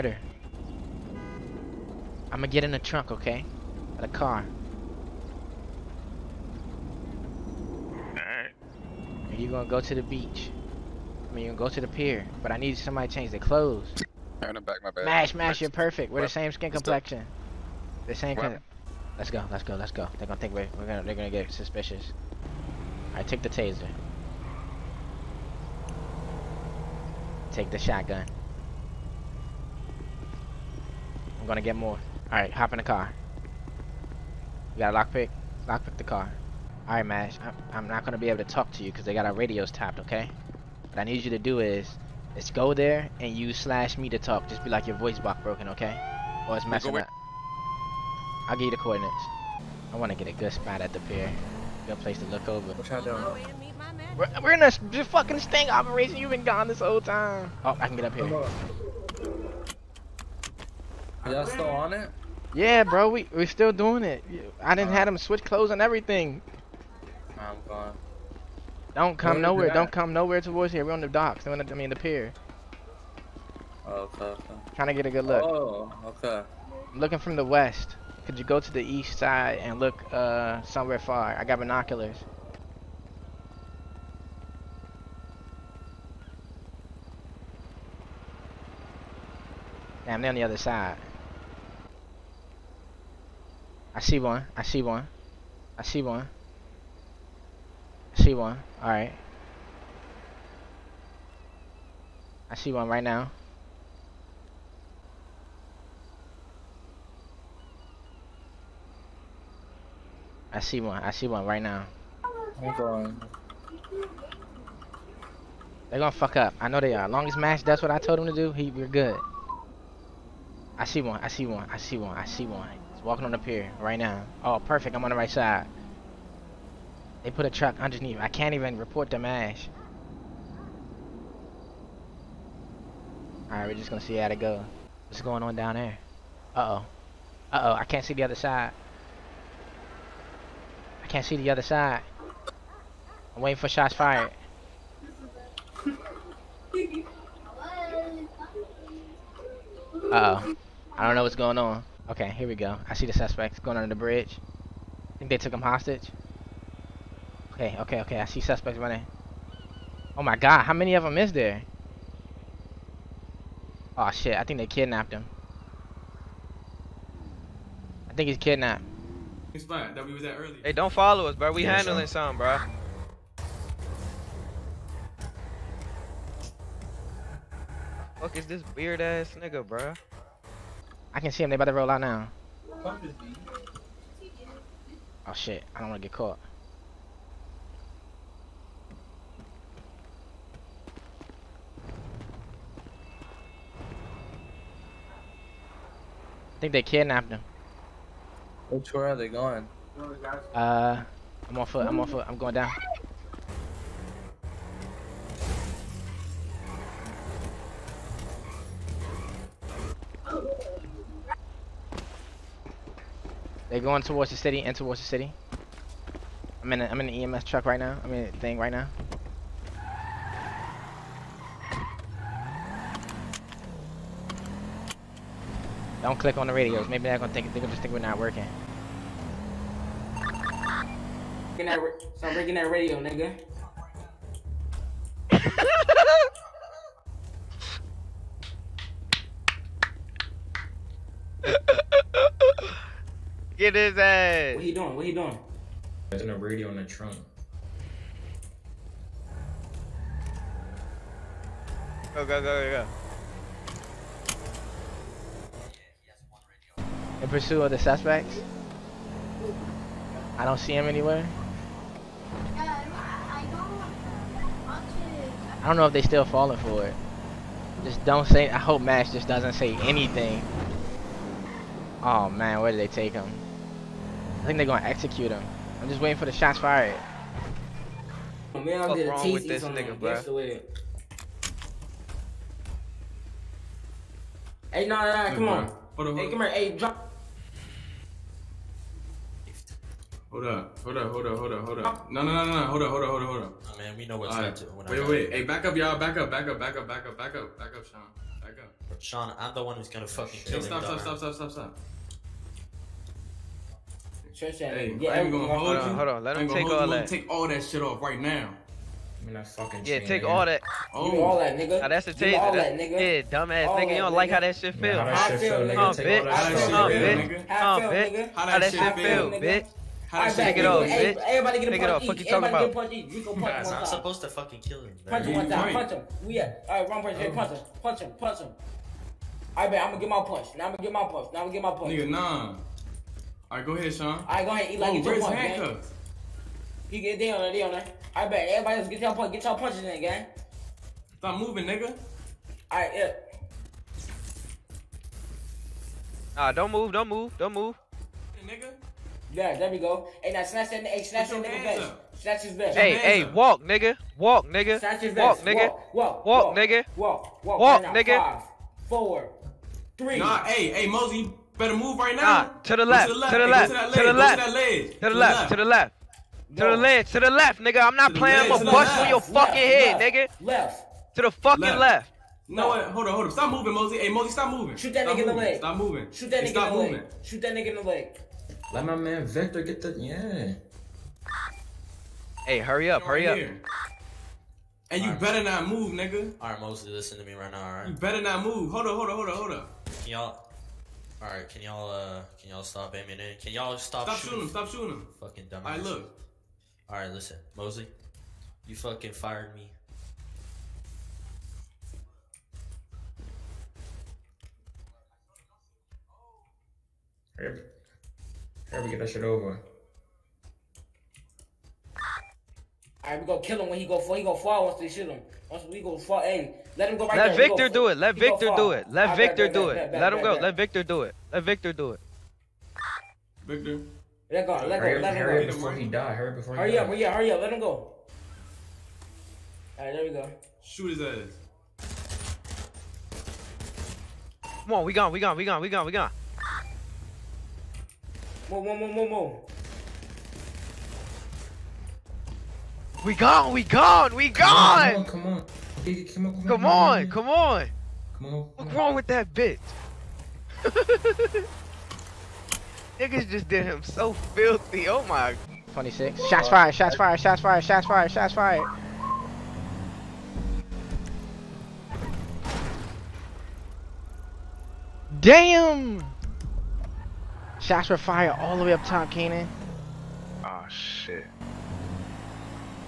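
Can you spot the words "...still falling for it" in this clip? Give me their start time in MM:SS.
04:26.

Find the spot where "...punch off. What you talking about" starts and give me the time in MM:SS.
05:21.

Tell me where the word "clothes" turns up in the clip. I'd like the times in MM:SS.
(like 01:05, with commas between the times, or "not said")
00:13, 01:05.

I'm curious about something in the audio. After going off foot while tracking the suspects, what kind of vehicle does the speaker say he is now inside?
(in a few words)
EMS truck.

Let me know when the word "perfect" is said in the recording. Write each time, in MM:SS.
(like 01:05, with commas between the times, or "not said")
00:15, 02:04.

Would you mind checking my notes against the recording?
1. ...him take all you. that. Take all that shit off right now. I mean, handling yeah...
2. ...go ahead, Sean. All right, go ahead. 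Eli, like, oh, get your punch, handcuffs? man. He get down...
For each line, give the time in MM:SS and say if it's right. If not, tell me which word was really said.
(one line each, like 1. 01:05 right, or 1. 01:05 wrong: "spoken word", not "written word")
1. 05:06 wrong: "fucking", not "handling"
2. 05:33 right.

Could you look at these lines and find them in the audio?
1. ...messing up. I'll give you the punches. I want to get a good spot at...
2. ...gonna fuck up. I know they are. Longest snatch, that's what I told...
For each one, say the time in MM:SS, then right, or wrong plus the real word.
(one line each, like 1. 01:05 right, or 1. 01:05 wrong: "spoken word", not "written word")
1. 00:46 wrong: "coordinates", not "punches"
2. 01:55 wrong: "match", not "snatch".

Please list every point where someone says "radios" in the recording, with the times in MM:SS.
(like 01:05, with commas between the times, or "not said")
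00:39, 03:46, 03:52, 04:06.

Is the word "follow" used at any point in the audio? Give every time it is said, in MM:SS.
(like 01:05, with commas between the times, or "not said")
02:50.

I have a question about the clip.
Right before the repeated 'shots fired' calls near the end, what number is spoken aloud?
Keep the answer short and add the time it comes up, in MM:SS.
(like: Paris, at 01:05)
26, at 07:35.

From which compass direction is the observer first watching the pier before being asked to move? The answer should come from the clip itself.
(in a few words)
West.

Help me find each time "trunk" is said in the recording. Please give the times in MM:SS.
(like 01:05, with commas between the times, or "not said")
00:02, 04:06.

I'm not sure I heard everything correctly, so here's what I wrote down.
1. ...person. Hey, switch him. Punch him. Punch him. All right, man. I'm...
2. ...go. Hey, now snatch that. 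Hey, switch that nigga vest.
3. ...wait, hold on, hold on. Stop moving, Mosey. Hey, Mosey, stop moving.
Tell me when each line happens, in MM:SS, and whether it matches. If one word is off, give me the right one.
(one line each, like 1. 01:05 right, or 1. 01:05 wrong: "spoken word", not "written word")
1. 05:27 wrong: "punch", not "switch"
2. 05:49 wrong: "snatch", not "switch"
3. 06:12 right.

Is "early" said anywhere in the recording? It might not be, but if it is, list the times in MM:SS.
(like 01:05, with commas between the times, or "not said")
02:50.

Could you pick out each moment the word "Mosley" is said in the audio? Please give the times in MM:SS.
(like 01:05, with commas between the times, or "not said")
06:26, 06:37.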